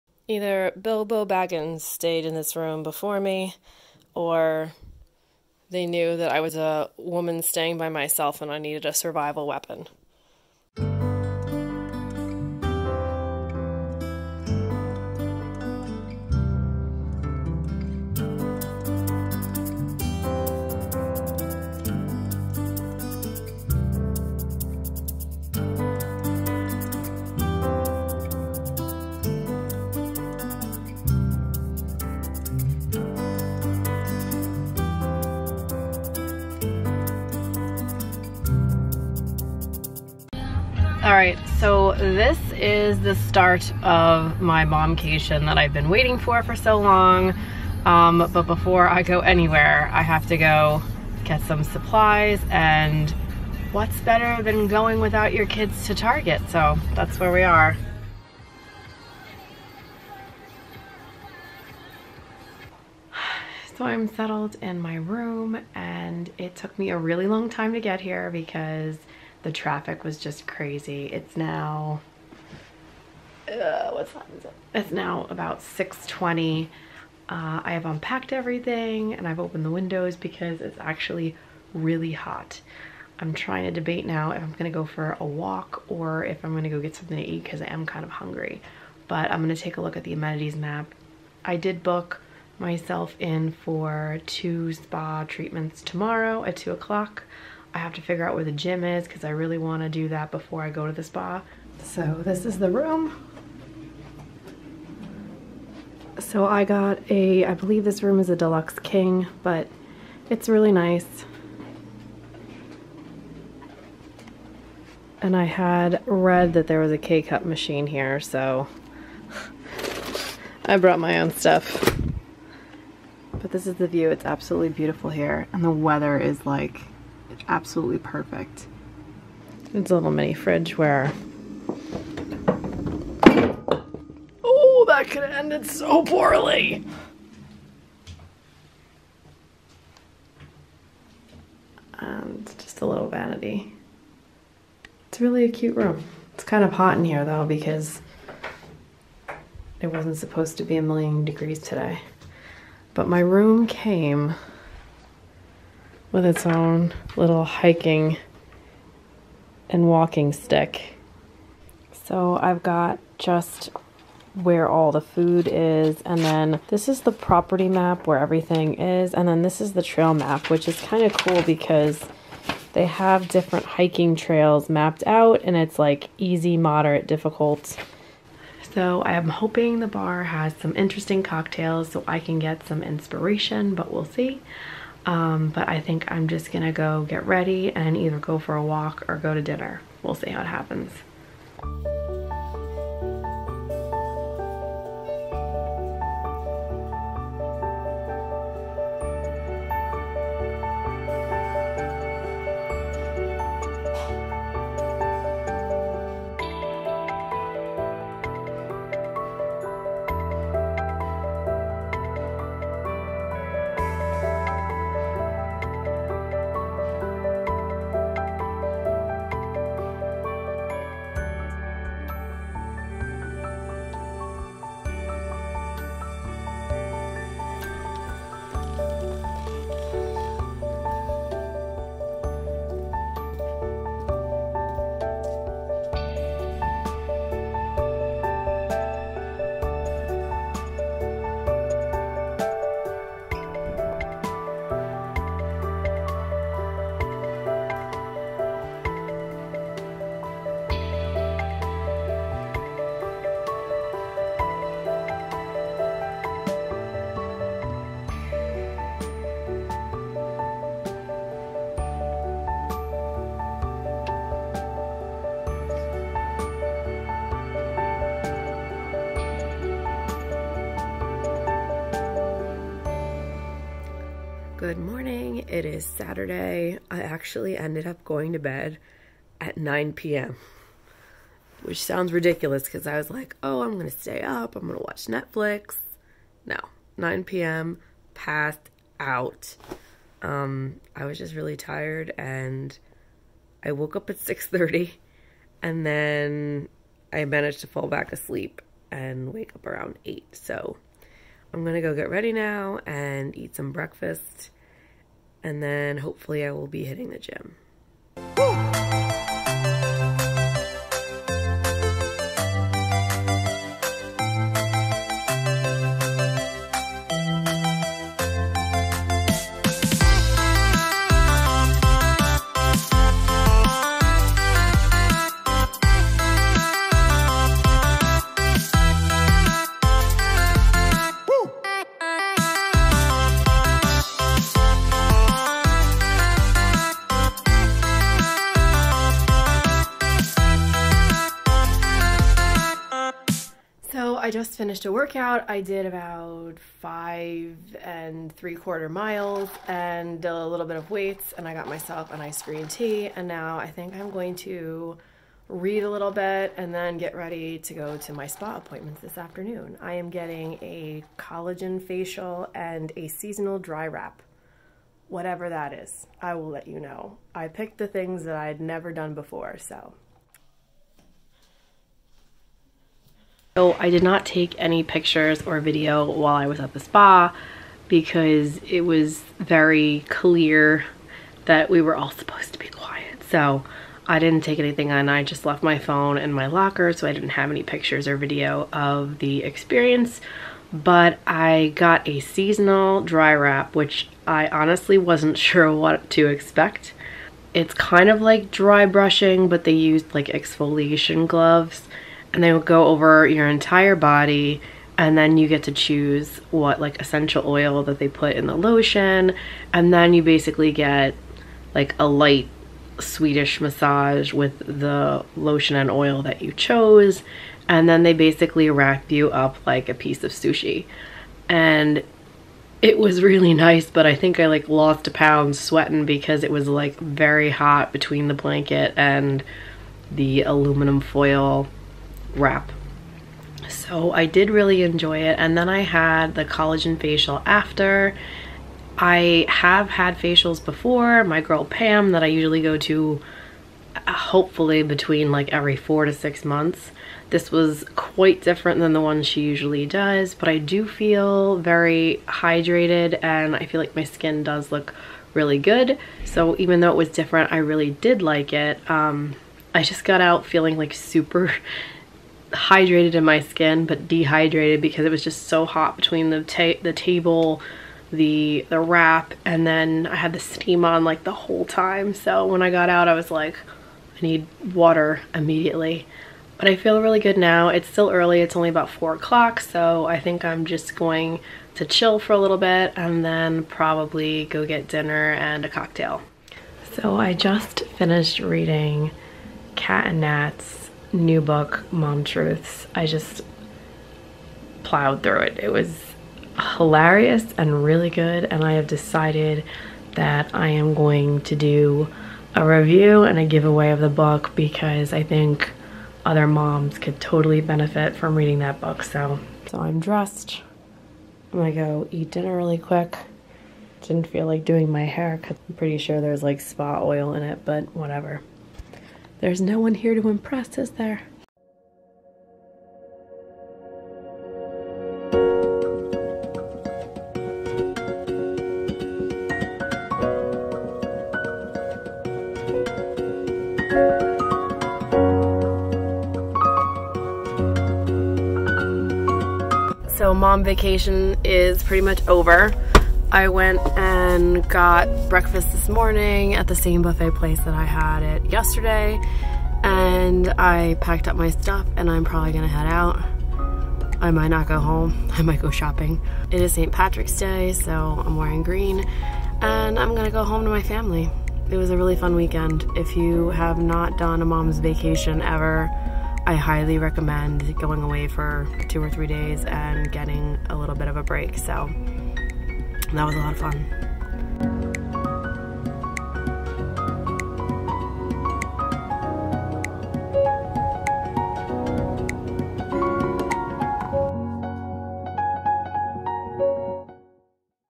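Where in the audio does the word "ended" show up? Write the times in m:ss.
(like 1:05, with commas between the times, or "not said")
2:15, 4:37.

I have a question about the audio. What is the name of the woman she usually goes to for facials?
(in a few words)
Pam.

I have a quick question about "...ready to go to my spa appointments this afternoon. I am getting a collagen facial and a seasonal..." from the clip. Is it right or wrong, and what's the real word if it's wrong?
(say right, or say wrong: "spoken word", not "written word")
right.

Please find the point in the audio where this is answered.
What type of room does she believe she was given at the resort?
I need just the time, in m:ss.
1:48.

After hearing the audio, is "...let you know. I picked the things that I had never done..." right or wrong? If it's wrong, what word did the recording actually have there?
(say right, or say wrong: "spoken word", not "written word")
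right.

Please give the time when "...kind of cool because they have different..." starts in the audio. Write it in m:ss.
2:50.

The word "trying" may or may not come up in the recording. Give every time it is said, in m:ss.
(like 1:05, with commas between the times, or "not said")
1:23.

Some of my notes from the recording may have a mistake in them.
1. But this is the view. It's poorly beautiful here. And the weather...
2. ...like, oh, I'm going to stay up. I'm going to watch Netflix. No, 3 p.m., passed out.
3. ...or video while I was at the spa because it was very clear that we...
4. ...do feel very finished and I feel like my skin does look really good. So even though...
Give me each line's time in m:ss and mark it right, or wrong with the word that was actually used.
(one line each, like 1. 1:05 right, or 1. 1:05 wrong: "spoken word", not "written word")
1. 2:03 wrong: "absolutely", not "poorly"
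2. 4:43 wrong: "9", not "3"
3. 6:15 right
4. 7:30 wrong: "hydrated", not "finished".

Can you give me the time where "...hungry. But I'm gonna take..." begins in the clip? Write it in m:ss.
1:28.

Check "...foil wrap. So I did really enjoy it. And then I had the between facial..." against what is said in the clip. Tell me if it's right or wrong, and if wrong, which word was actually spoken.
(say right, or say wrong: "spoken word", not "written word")
wrong: "collagen", not "between".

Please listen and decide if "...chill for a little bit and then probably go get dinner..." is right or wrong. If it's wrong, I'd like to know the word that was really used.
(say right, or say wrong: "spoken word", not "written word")
right.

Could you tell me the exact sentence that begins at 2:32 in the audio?
But my room came with its own little hiking and walking stick.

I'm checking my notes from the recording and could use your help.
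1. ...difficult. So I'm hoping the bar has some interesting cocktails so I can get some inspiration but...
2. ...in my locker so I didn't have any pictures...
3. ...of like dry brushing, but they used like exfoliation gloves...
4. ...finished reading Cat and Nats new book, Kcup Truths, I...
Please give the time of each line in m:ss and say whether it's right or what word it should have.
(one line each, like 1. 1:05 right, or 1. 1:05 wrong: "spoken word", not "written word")
1. 2:57 right
2. 6:26 right
3. 6:38 right
4. 8:07 wrong: "Mom", not "Kcup".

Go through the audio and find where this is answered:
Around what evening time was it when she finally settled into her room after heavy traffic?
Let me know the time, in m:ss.
1:15.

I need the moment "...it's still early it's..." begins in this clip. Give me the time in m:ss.
7:57.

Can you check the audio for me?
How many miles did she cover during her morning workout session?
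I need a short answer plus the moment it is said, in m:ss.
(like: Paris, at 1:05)
5 and 3/4 miles, at 5:46.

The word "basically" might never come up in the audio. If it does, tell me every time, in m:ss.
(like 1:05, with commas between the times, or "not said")
6:50, 6:58.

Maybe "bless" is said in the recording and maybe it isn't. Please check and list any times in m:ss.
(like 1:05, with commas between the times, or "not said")
not said.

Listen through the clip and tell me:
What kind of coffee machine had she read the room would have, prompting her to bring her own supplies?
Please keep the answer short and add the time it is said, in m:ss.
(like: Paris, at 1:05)
K-cup machine, at 1:56.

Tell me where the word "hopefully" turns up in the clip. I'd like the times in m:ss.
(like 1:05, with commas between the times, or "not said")
5:05, 7:24.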